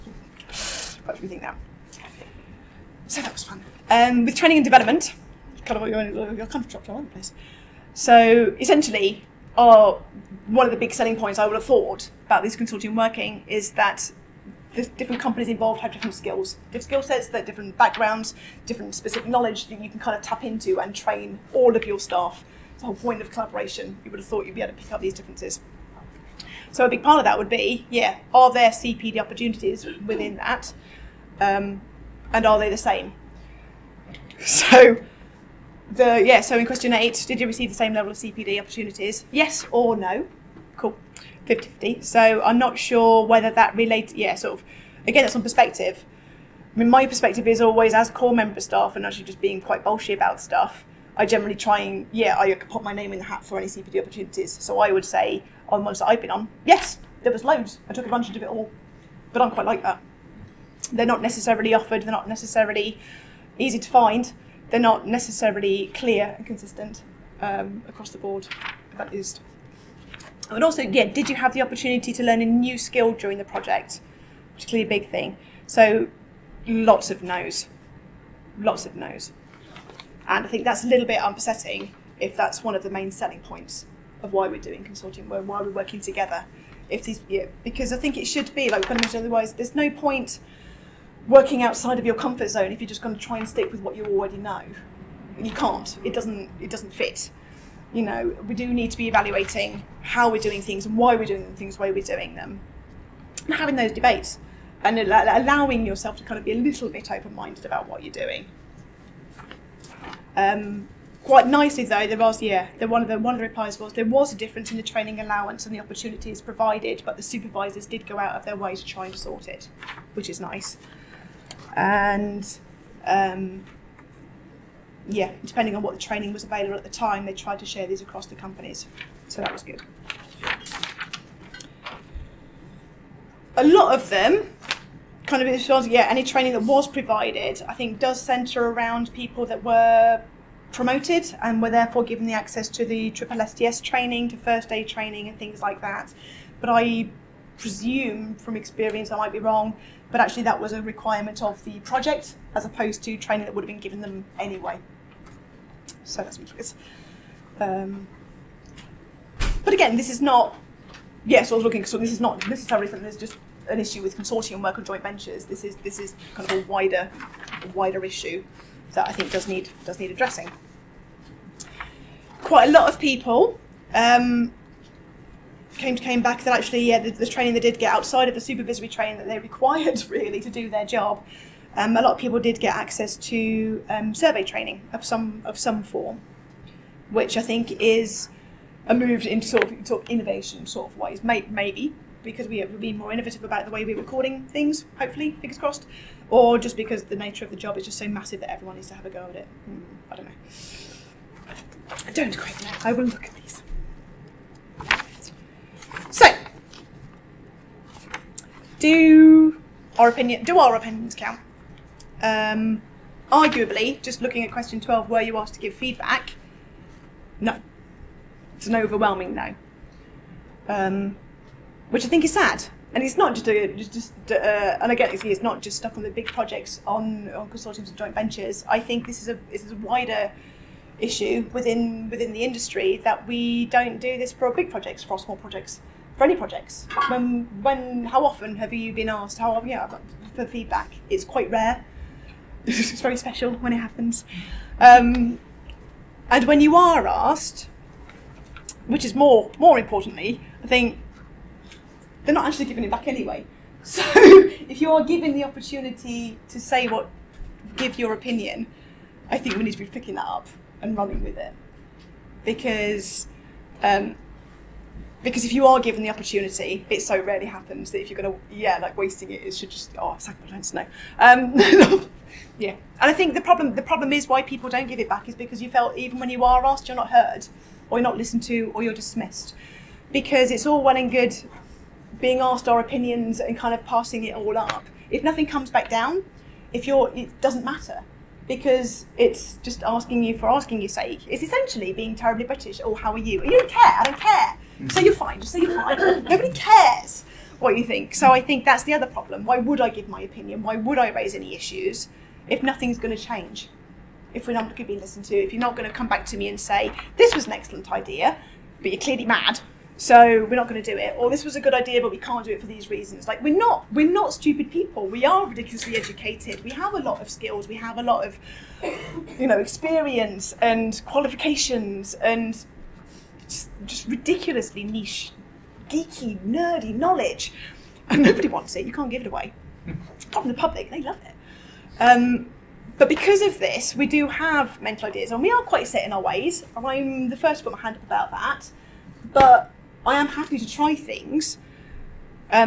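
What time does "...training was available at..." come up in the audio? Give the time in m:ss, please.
2:05.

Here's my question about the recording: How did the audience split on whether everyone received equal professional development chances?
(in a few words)
50-50.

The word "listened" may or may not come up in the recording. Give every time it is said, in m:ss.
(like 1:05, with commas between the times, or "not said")
4:38, 5:04.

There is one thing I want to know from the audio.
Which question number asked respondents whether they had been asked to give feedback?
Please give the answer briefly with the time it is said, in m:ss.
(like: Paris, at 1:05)
12, at 3:34.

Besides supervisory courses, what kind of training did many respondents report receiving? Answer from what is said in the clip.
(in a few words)
Survey training.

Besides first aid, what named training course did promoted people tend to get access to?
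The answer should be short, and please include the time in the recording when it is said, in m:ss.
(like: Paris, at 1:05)
Triple STS, at 2:23.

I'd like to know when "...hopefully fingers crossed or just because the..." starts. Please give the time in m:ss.
3:14.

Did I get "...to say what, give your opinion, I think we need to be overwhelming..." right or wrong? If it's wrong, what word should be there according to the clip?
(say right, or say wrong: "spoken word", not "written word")
wrong: "picking", not "overwhelming".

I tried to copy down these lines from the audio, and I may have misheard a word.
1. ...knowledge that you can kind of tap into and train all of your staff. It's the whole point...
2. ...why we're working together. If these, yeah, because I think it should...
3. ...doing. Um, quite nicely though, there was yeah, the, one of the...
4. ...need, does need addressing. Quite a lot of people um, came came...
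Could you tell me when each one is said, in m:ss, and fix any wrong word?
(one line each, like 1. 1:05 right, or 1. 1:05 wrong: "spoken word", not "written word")
1. 0:19 right
2. 1:25 right
3. 1:48 right
4. 2:49 right.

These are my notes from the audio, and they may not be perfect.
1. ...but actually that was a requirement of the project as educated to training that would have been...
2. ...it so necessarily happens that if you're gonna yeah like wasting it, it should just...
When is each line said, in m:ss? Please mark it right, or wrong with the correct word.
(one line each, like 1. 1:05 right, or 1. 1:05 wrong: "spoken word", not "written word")
1. 2:30 wrong: "opposed", not "educated"
2. 4:26 wrong: "rarely", not "necessarily".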